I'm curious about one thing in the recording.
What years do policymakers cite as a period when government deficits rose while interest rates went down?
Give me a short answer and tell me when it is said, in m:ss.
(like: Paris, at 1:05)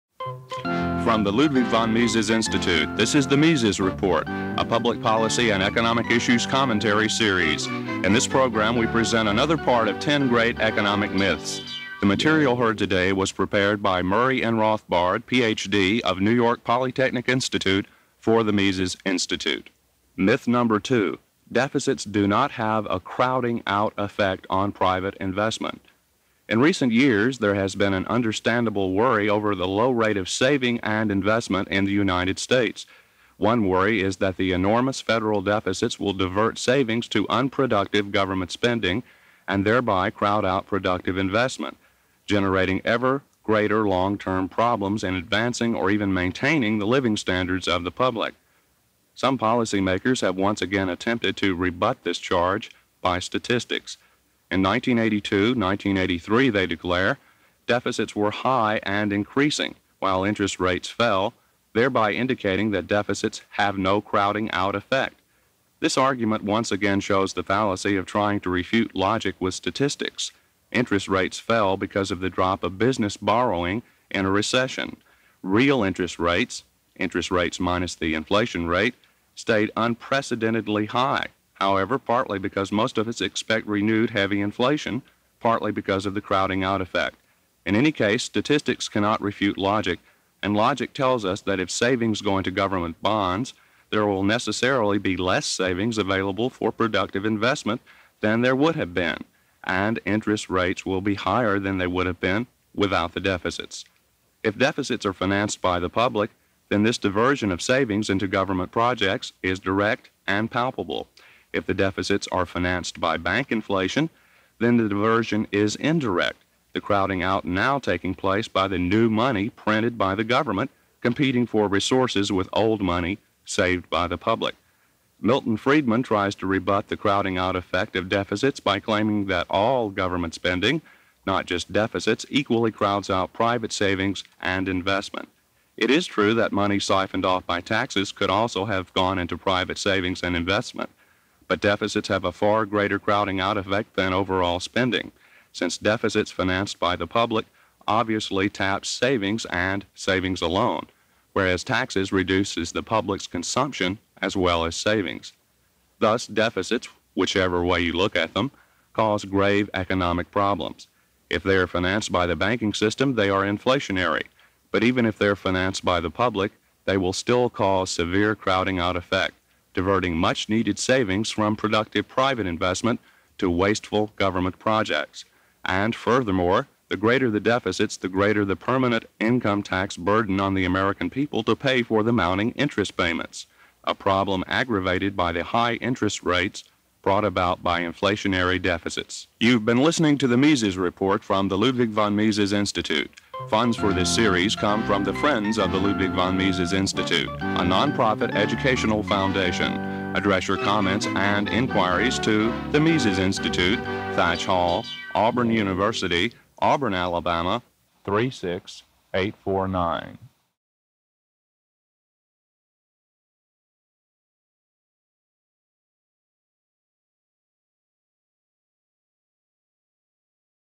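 1982 1983, at 0:54.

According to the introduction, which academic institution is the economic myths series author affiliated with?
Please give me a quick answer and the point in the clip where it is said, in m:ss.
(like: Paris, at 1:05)
New York Polytechnic Institute, at 0:16.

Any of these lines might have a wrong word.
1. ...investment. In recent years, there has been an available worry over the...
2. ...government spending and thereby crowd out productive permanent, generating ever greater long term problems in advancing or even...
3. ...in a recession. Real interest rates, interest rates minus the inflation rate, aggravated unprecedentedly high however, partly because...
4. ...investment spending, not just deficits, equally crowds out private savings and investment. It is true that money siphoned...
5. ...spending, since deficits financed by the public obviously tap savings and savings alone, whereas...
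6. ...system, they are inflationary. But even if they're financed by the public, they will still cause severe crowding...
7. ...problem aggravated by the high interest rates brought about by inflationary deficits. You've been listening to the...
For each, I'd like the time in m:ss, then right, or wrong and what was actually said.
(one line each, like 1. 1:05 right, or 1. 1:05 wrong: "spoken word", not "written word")
1. 0:25 wrong: "understandable", not "available"
2. 0:38 wrong: "investment", not "permanent"
3. 1:14 wrong: "stayed", not "aggravated"
4. 2:09 wrong: "government", not "investment"
5. 2:24 right
6. 2:42 right
7. 3:03 right.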